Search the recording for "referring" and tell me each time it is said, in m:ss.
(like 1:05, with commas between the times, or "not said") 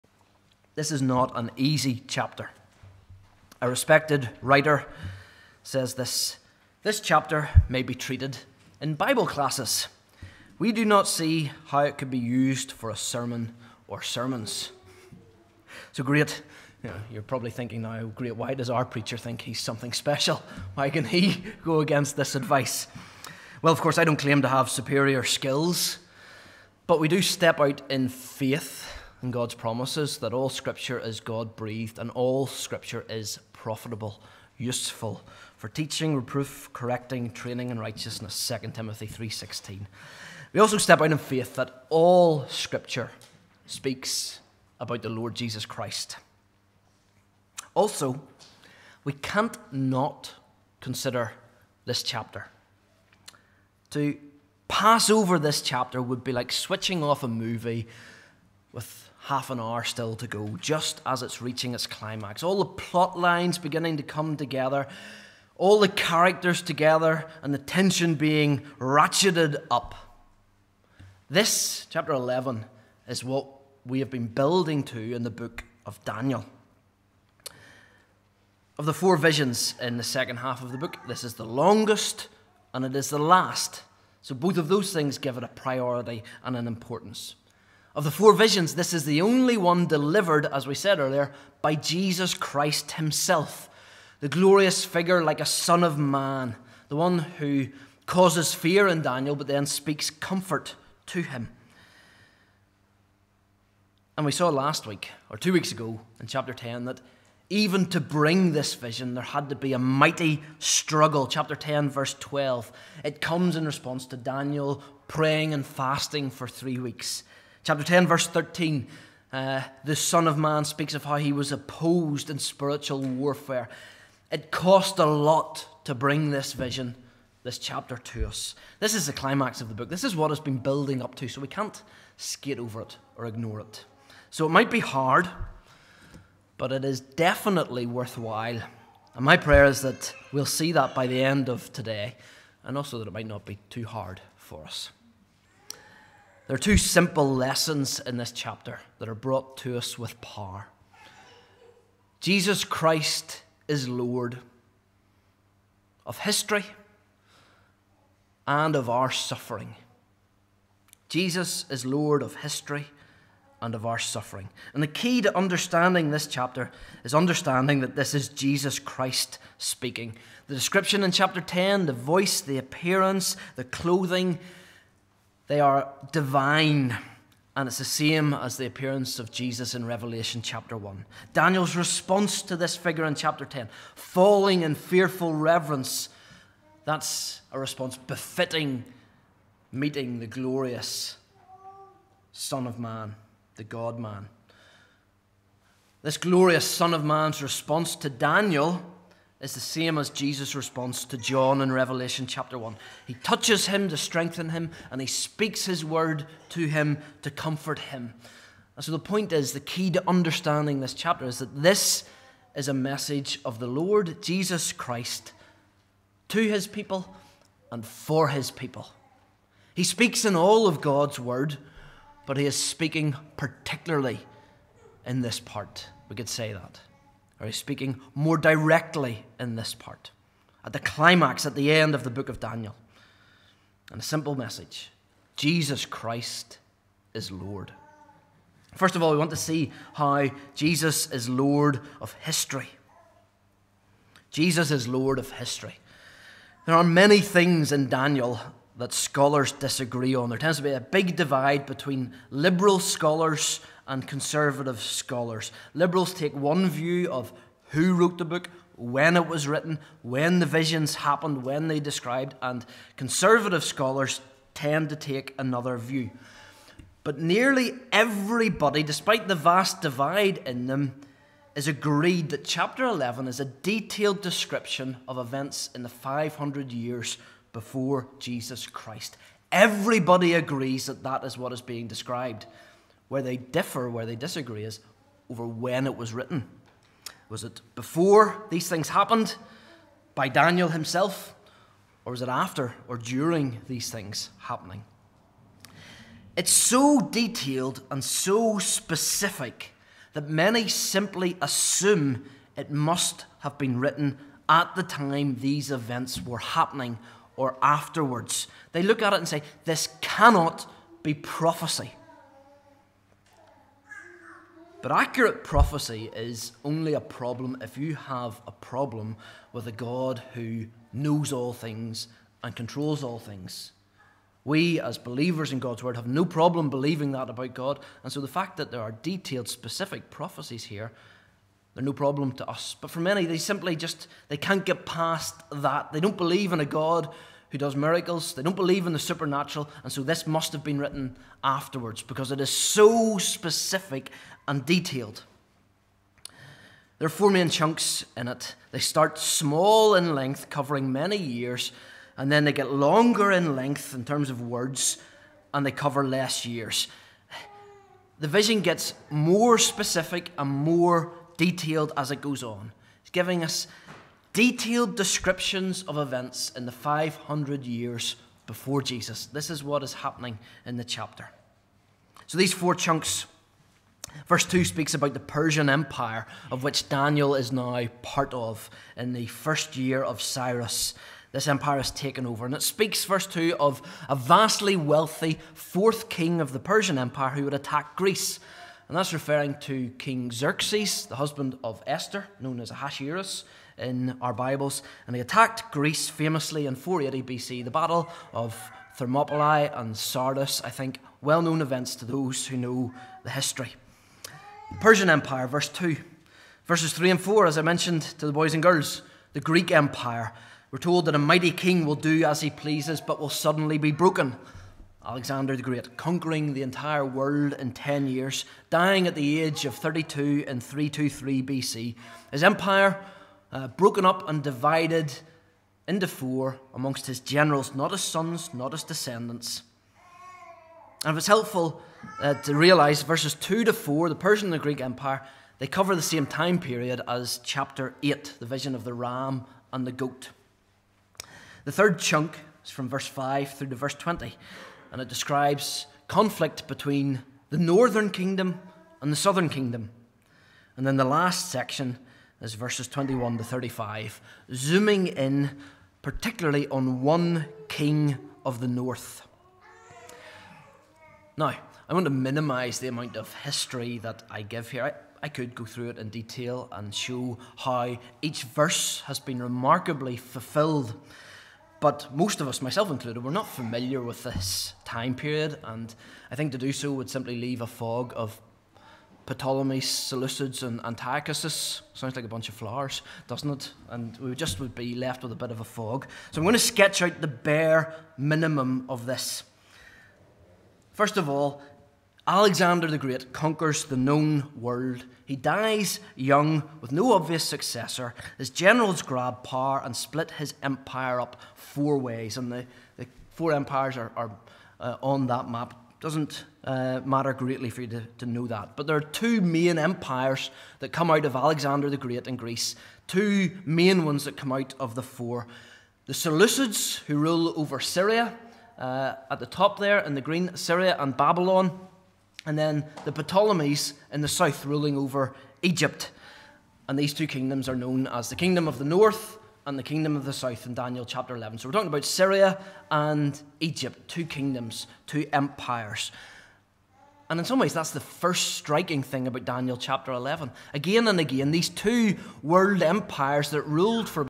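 6:29.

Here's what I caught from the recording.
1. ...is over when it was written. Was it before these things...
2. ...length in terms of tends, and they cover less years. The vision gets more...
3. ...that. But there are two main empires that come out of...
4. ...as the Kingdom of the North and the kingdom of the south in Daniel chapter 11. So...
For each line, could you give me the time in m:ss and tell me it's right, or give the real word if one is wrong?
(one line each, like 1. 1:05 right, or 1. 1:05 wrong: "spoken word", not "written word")
1. 4:44 right
2. 5:53 wrong: "words", not "tends"
3. 8:28 right
4. 8:48 right.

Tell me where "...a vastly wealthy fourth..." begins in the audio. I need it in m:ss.
6:24.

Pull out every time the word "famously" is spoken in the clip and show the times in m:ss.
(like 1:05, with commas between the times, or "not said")
6:36.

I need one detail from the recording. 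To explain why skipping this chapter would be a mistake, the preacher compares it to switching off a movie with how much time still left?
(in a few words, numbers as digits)
half an hour.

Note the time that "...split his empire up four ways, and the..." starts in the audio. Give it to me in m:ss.
8:19.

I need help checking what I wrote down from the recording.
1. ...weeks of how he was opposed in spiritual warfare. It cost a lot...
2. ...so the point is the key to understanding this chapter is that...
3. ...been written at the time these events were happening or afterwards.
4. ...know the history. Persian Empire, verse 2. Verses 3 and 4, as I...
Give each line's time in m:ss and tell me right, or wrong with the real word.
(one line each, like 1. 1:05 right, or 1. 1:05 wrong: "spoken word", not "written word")
1. 2:00 wrong: "speaks", not "weeks"
2. 3:28 right
3. 5:03 right
4. 6:42 right.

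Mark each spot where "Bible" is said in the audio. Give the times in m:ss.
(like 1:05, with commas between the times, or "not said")
0:08, 6:34.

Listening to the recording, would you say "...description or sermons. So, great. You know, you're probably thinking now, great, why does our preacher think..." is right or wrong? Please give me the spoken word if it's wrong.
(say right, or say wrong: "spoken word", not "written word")
wrong: "sermon", not "description".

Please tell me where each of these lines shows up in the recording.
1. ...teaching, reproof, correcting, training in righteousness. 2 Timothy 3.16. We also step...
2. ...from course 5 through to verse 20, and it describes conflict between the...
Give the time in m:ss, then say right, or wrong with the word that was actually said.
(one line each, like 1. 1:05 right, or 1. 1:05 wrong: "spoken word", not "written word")
1. 0:35 right
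2. 7:22 wrong: "verse", not "course".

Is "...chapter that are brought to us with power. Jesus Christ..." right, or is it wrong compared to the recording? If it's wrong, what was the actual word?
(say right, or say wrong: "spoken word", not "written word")
right.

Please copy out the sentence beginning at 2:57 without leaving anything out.
And it's the same as the appearance of Jesus in Revelation chapter 1.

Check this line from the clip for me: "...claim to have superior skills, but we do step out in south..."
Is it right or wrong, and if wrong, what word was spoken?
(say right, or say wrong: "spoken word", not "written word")
wrong: "faith", not "south".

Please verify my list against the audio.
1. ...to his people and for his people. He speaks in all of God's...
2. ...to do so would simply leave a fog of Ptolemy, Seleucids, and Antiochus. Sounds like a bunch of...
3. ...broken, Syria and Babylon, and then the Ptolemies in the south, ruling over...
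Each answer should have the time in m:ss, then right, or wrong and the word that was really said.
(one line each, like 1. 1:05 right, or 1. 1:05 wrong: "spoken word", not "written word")
1. 3:36 right
2. 7:56 right
3. 8:40 wrong: "green", not "broken".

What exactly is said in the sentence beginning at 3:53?
And a simple message Jesus Christ is Lord.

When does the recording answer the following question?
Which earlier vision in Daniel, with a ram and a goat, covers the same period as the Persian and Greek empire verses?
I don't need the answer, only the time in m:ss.
7:17.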